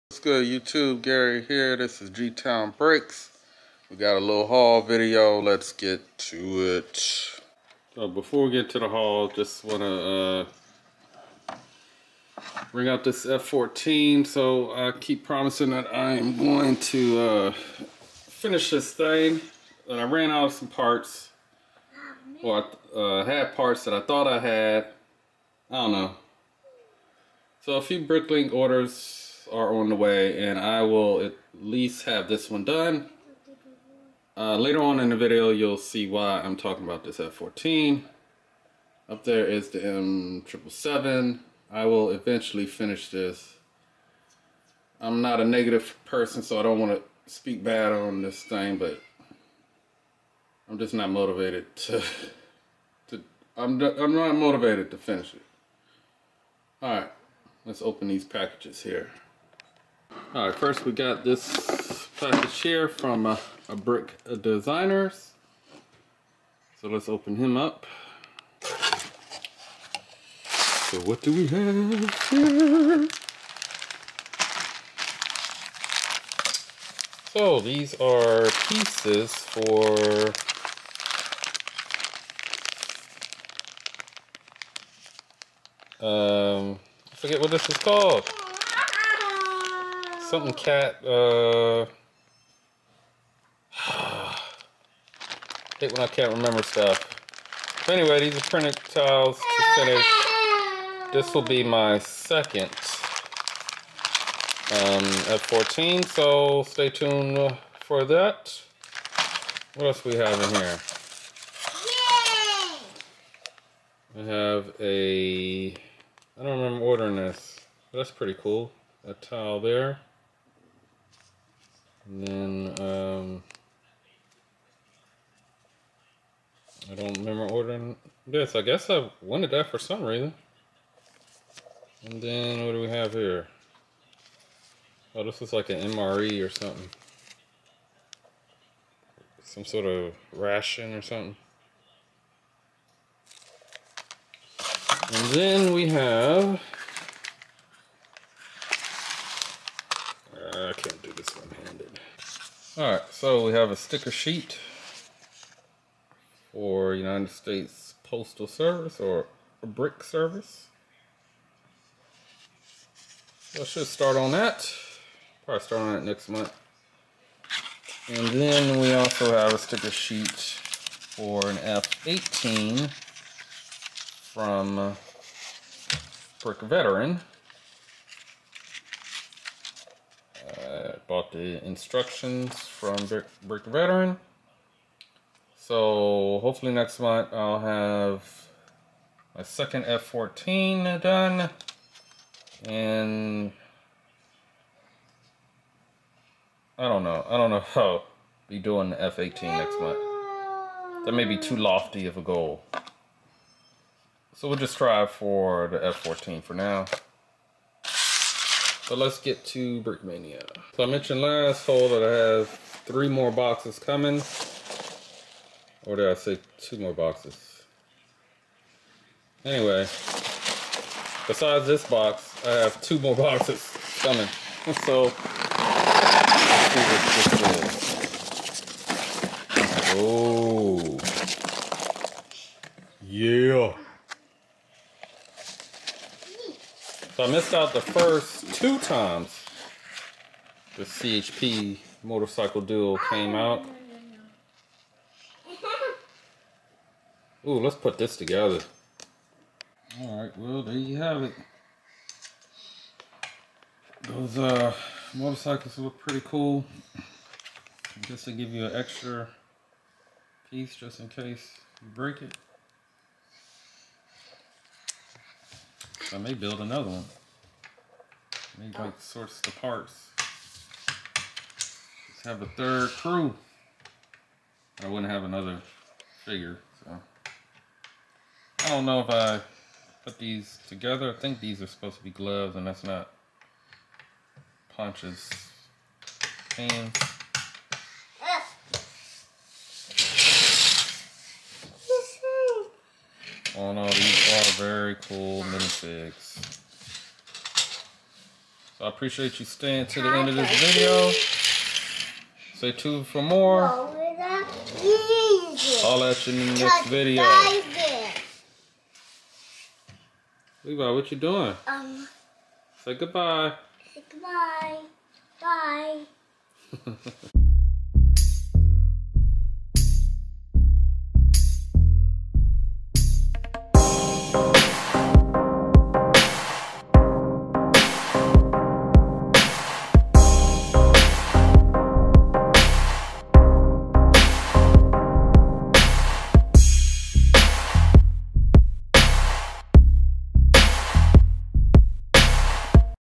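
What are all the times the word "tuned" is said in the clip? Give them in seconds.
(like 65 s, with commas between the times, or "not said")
106 s, 302 s.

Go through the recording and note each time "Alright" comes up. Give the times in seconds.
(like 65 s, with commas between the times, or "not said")
56 s, 152 s, 250 s.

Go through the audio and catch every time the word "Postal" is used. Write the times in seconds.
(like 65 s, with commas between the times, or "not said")
158 s.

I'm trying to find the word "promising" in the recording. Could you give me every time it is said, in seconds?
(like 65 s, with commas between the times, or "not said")
15 s.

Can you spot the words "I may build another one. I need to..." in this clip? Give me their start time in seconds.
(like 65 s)
266 s.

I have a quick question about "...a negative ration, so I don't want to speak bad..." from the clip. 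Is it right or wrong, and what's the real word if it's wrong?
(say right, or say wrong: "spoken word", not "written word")
wrong: "person", not "ration".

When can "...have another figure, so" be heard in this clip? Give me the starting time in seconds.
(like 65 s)
275 s.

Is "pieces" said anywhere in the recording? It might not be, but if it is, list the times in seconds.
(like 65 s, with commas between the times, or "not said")
78 s, 260 s.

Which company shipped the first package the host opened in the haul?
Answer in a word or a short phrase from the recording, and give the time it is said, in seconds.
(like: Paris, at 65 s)
Brick Designers, at 63 s.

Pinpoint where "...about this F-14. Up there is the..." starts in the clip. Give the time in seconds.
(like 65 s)
36 s.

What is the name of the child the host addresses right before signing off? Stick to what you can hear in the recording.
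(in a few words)
Levi.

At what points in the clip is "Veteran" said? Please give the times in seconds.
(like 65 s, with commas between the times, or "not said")
176 s, 183 s.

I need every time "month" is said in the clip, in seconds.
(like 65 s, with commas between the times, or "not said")
166 s, 187 s, 199 s.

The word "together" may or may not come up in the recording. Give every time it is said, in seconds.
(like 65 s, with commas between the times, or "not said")
248 s, 280 s.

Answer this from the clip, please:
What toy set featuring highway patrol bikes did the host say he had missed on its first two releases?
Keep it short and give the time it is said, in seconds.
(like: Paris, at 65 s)
CHP motorcycle duel, at 240 s.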